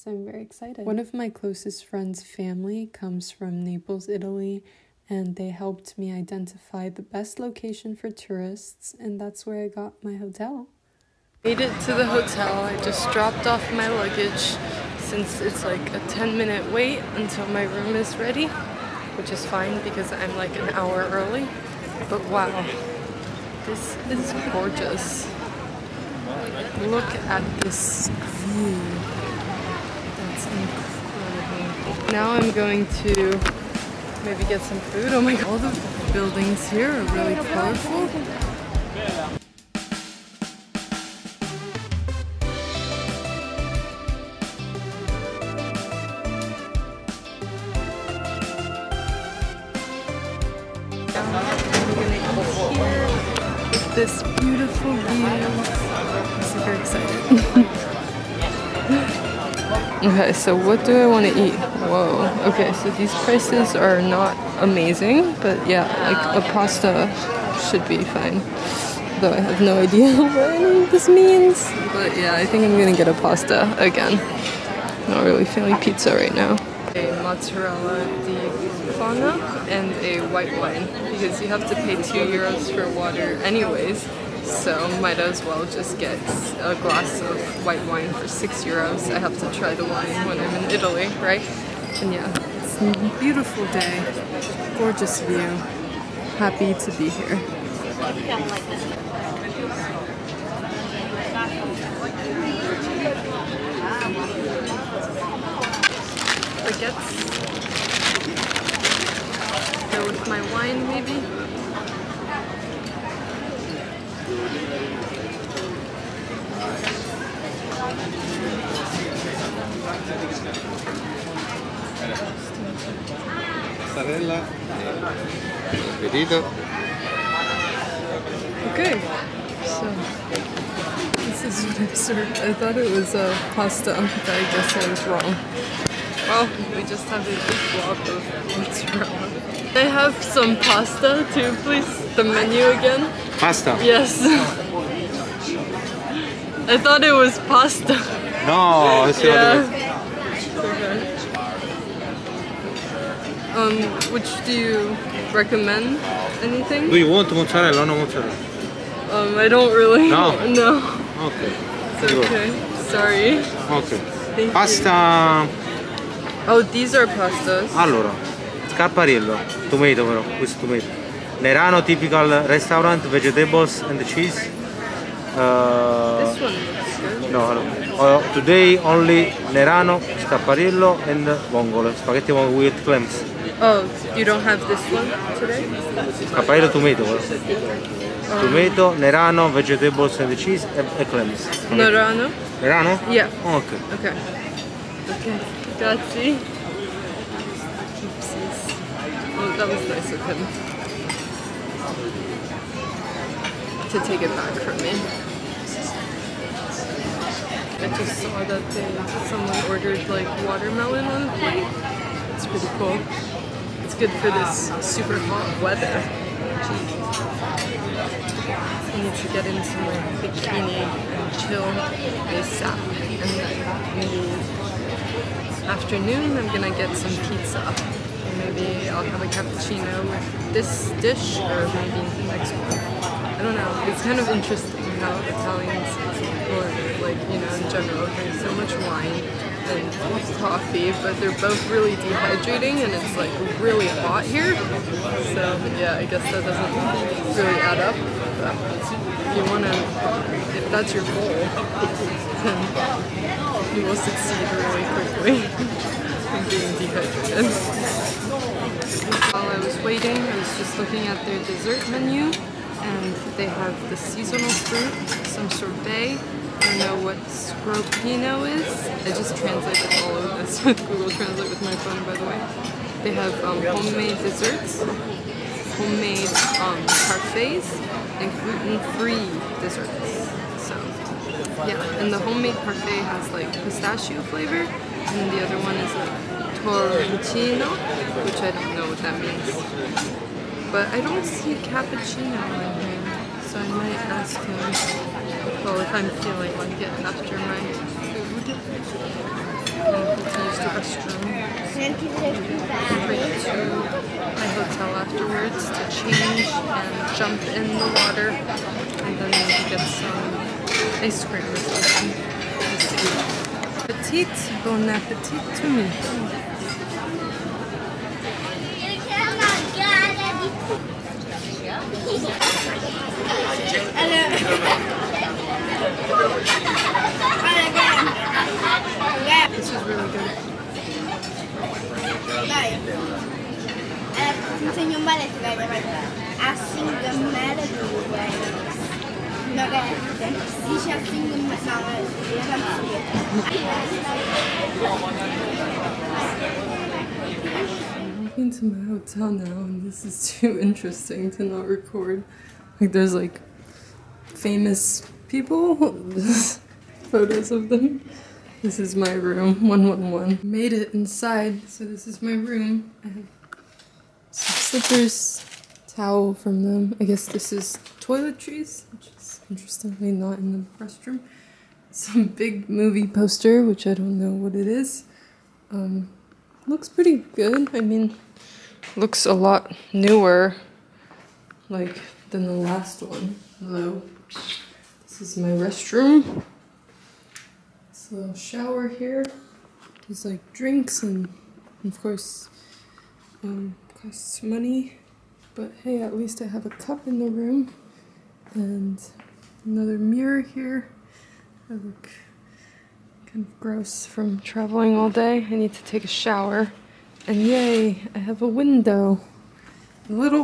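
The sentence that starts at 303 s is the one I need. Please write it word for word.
Right to my hotel afterwards to change and jump in the water, and then maybe get some ice cream or something.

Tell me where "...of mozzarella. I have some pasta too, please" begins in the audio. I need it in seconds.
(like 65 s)
138 s.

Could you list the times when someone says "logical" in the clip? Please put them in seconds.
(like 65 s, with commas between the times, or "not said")
not said.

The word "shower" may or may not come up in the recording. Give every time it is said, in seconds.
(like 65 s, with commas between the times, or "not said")
388 s, 406 s.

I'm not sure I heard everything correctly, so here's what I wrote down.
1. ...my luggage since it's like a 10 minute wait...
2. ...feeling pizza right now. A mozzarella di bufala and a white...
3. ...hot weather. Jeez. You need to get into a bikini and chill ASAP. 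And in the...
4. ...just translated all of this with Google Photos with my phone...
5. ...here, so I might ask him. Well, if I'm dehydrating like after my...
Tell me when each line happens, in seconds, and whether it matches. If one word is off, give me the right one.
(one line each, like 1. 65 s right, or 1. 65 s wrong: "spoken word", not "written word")
1. 13 s right
2. 75 s right
3. 215 s right
4. 269 s wrong: "Translate", not "Photos"
5. 292 s wrong: "feeling", not "dehydrating".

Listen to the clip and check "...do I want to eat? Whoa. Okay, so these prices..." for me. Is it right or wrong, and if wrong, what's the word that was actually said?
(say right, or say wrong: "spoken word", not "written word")
right.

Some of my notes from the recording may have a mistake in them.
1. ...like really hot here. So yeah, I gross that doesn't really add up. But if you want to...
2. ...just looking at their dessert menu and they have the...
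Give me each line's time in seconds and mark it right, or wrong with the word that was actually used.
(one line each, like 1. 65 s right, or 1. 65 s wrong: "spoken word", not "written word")
1. 243 s wrong: "guess", not "gross"
2. 260 s right.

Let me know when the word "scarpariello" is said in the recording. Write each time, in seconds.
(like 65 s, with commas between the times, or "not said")
168 s, 180 s.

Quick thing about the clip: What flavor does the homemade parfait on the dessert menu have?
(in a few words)
Pistachio.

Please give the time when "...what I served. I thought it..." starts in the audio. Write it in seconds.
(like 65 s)
131 s.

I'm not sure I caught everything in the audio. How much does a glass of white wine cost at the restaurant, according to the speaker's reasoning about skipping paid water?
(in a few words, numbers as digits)
6 euros.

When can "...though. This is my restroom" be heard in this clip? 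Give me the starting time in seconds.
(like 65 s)
383 s.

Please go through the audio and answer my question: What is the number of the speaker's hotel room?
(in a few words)
111.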